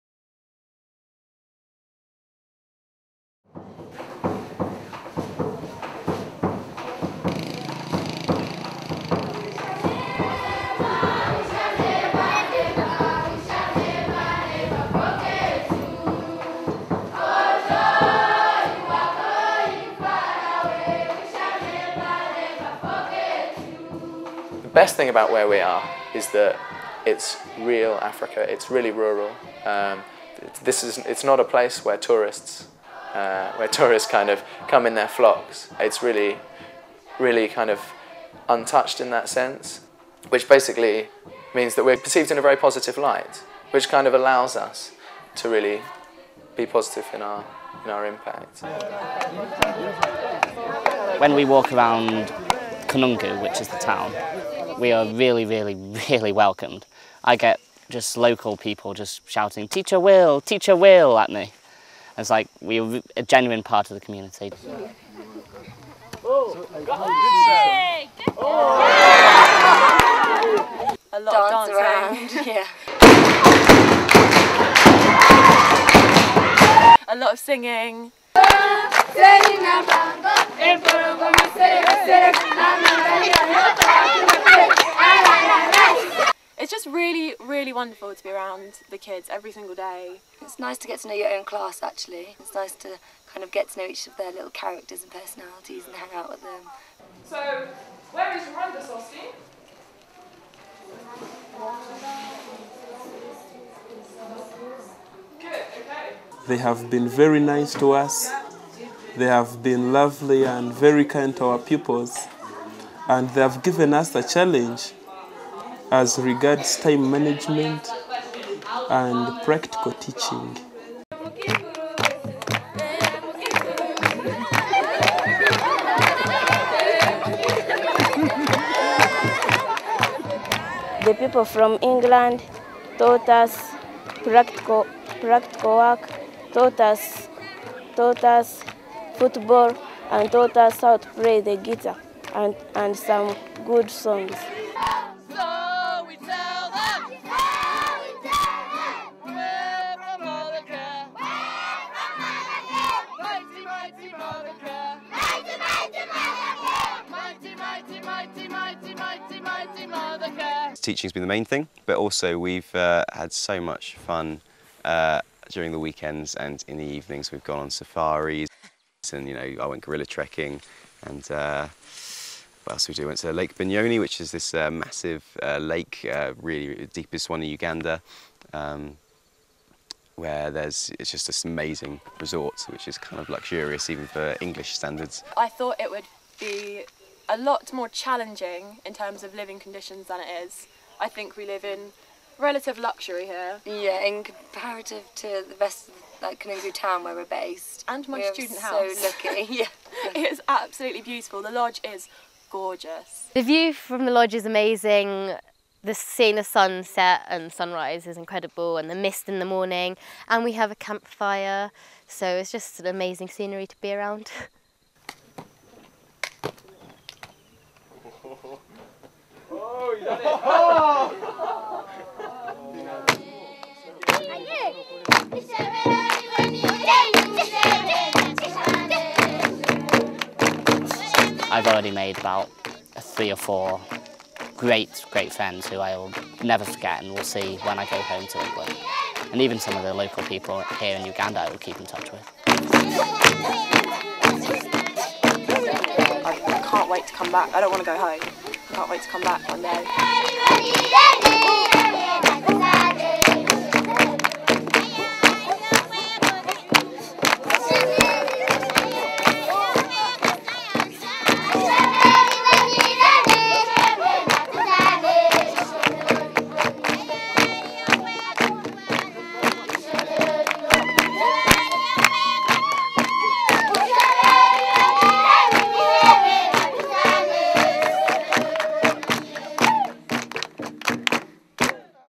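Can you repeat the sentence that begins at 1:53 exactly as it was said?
And they have given us a challenge as regards time management and practical teaching.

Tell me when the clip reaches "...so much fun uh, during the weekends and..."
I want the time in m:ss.
2:43.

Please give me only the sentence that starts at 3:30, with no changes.
And we have a campfire, so it's just an amazing scenery to be around.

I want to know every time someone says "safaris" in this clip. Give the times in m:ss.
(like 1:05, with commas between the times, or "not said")
2:47.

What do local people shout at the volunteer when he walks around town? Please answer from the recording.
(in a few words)
Teacher Will.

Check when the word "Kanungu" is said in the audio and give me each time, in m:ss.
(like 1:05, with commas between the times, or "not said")
0:52, 3:16.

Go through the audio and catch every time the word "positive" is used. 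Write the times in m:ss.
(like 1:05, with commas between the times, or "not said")
0:42, 0:46.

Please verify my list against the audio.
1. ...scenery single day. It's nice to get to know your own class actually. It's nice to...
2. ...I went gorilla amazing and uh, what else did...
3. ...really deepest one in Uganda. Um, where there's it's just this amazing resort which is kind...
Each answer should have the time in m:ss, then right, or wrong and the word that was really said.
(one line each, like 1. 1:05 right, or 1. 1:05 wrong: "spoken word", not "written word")
1. 1:29 wrong: "every", not "scenery"
2. 2:49 wrong: "trekking", not "amazing"
3. 2:56 right.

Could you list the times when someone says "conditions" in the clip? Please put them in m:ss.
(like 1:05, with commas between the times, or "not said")
3:09.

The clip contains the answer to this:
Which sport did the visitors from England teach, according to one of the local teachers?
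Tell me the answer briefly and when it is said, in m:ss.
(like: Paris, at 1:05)
Football, at 2:19.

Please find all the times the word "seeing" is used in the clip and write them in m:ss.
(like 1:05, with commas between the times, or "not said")
3:25.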